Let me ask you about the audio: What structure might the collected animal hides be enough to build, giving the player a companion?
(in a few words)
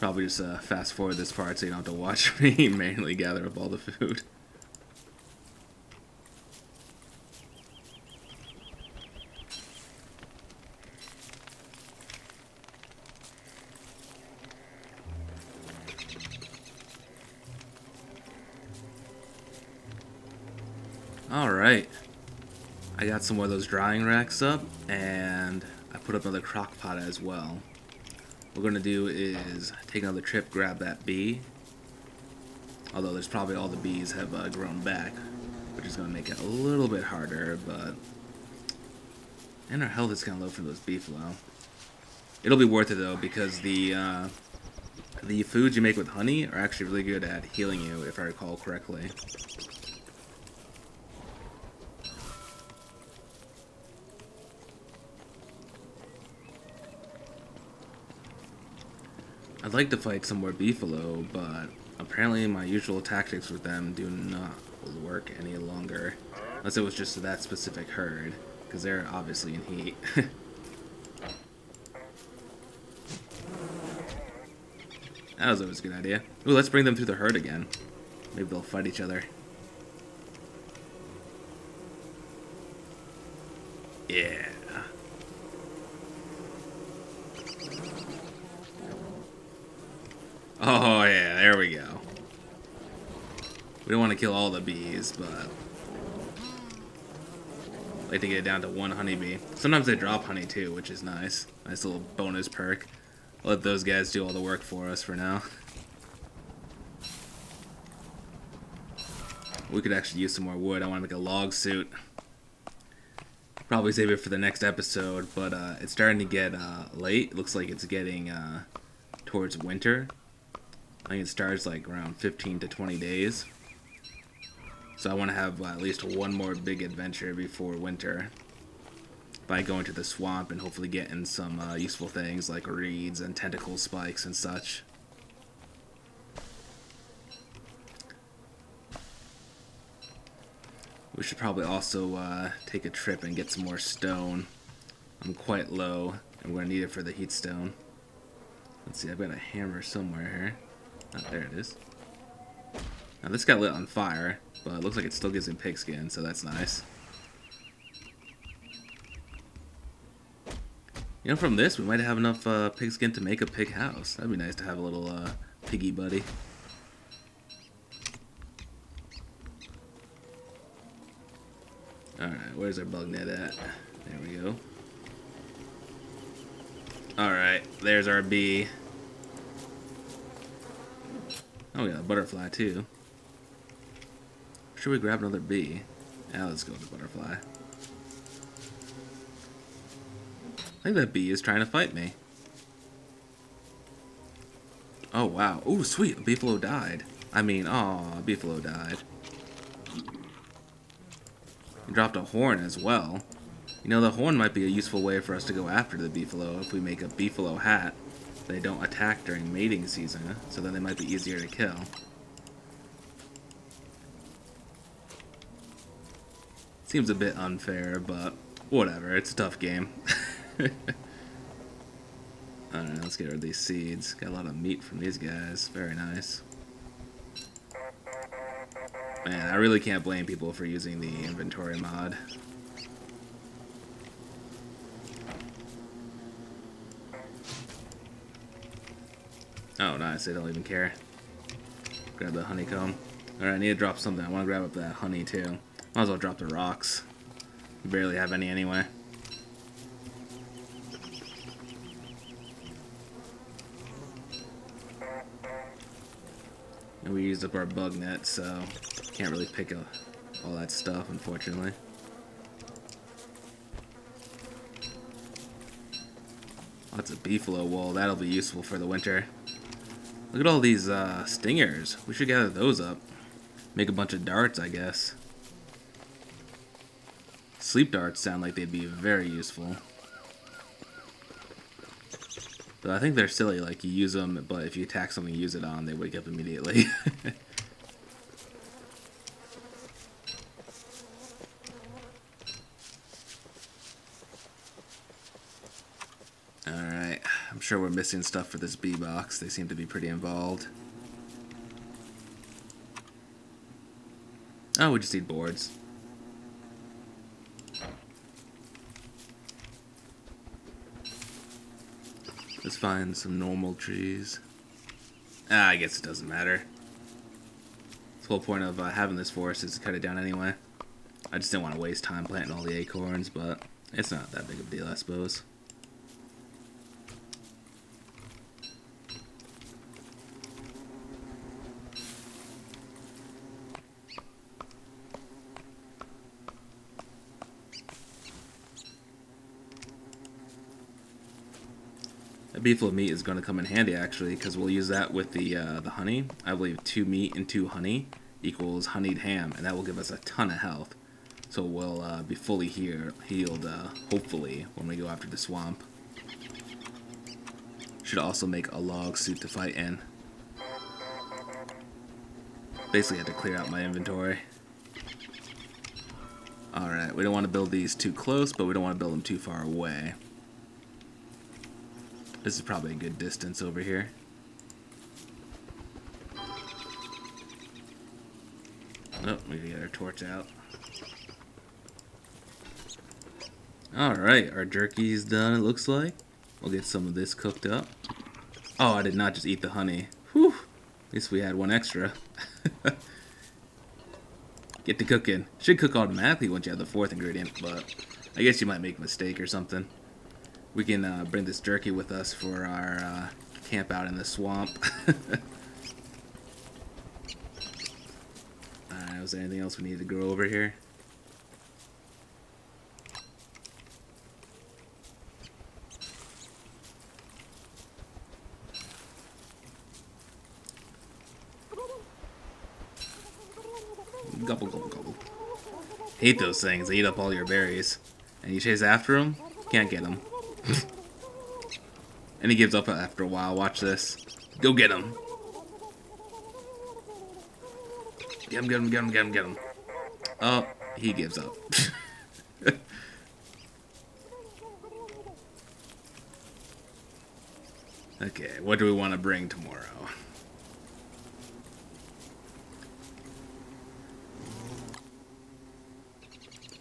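A pig house.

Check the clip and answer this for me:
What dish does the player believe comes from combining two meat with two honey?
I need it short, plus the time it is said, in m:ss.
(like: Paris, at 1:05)
Honeyed ham, at 5:48.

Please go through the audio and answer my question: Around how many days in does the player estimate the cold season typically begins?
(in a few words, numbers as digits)
15 to 20 days.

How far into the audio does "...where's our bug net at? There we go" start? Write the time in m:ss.
2:52.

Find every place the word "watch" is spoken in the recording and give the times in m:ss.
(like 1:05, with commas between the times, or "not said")
0:01, 7:13.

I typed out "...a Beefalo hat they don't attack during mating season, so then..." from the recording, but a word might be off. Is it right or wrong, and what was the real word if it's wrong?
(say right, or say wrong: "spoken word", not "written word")
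right.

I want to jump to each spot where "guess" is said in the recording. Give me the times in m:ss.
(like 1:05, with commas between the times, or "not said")
4:34, 5:15, 6:38.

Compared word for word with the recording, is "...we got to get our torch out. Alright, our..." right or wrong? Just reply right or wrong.
right.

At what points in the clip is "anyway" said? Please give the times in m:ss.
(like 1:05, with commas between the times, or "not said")
4:08, 5:20.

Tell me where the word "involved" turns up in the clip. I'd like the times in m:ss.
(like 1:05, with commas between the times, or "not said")
5:00.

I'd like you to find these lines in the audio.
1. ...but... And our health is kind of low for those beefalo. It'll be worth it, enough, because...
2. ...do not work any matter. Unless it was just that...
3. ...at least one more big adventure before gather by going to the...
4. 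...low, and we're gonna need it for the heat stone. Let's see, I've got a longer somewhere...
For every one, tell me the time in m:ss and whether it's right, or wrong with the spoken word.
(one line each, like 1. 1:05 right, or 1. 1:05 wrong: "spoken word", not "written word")
1. 0:37 wrong: "though", not "enough"
2. 1:03 wrong: "longer", not "matter"
3. 2:05 wrong: "winter", not "gather"
4. 2:25 wrong: "hammer", not "longer".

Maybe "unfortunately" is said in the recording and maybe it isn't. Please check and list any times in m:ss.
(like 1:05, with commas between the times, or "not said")
4:21.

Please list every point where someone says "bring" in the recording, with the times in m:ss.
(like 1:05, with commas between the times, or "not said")
1:16, 6:41, 7:29.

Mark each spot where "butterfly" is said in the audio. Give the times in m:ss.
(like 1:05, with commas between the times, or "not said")
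3:02, 3:06.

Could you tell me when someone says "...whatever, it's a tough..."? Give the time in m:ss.
3:38.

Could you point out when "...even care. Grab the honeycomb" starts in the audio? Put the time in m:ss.
4:00.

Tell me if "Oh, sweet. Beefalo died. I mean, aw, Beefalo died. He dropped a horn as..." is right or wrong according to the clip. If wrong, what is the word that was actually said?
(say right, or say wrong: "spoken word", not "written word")
right.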